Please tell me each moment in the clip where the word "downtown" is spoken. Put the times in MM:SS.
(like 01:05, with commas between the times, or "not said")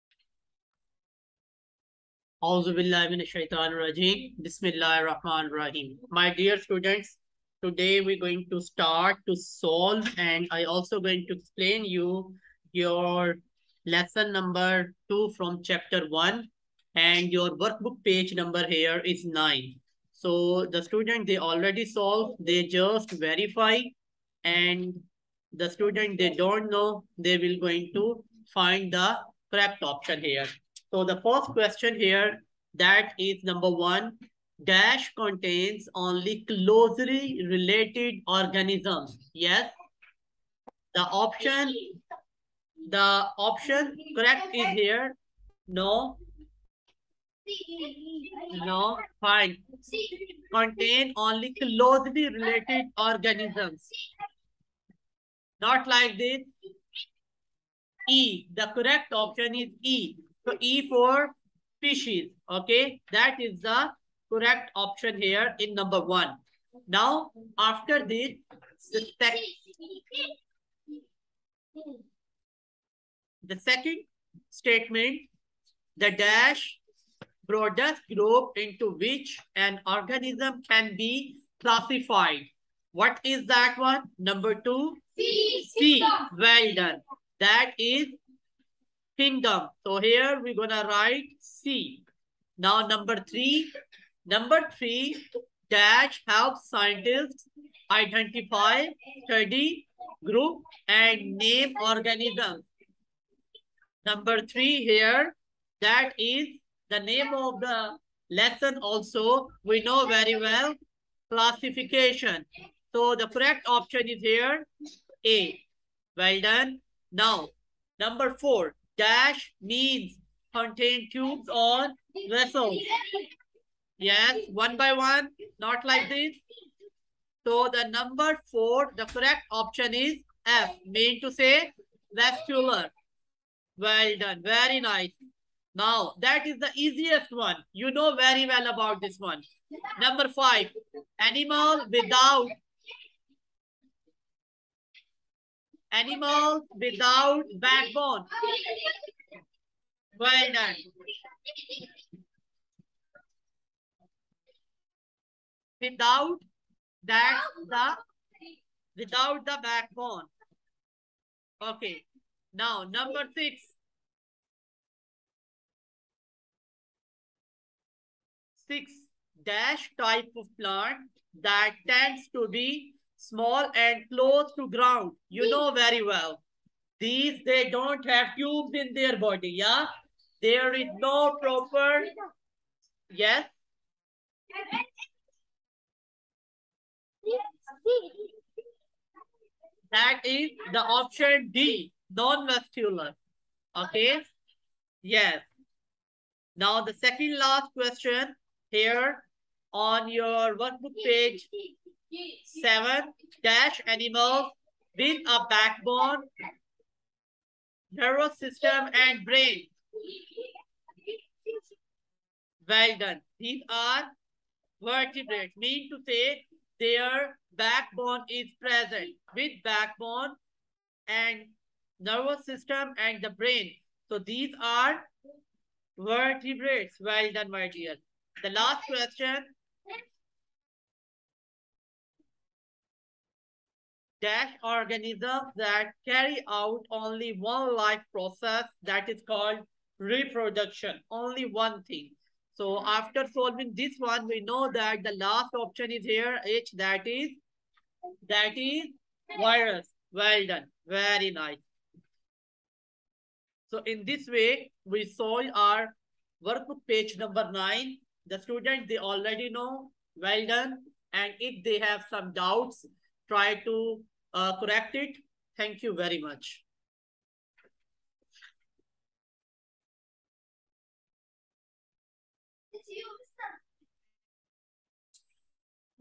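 not said.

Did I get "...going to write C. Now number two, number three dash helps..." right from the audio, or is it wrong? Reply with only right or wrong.
wrong.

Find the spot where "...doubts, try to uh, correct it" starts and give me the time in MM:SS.
04:22.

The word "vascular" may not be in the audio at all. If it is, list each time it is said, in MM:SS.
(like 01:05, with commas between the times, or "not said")
02:12, 03:12.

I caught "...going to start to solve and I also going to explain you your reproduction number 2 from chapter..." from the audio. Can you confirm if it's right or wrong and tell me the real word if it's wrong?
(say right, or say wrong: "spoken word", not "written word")
wrong: "lesson", not "reproduction".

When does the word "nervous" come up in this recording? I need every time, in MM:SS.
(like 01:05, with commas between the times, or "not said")
03:27, 03:41.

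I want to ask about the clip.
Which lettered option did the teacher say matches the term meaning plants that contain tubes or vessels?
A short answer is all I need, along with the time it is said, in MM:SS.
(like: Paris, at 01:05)
F, at 02:10.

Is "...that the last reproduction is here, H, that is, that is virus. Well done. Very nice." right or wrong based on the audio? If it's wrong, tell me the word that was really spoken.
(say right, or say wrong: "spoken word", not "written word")
wrong: "option", not "reproduction".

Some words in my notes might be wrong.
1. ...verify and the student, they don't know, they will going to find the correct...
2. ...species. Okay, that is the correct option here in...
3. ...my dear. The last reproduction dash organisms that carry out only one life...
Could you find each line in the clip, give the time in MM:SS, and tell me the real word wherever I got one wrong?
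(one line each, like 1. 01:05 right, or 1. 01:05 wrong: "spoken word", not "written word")
1. 00:23 right
2. 01:01 right
3. 03:47 wrong: "question", not "reproduction".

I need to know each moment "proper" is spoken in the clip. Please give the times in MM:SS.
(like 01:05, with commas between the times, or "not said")
03:01.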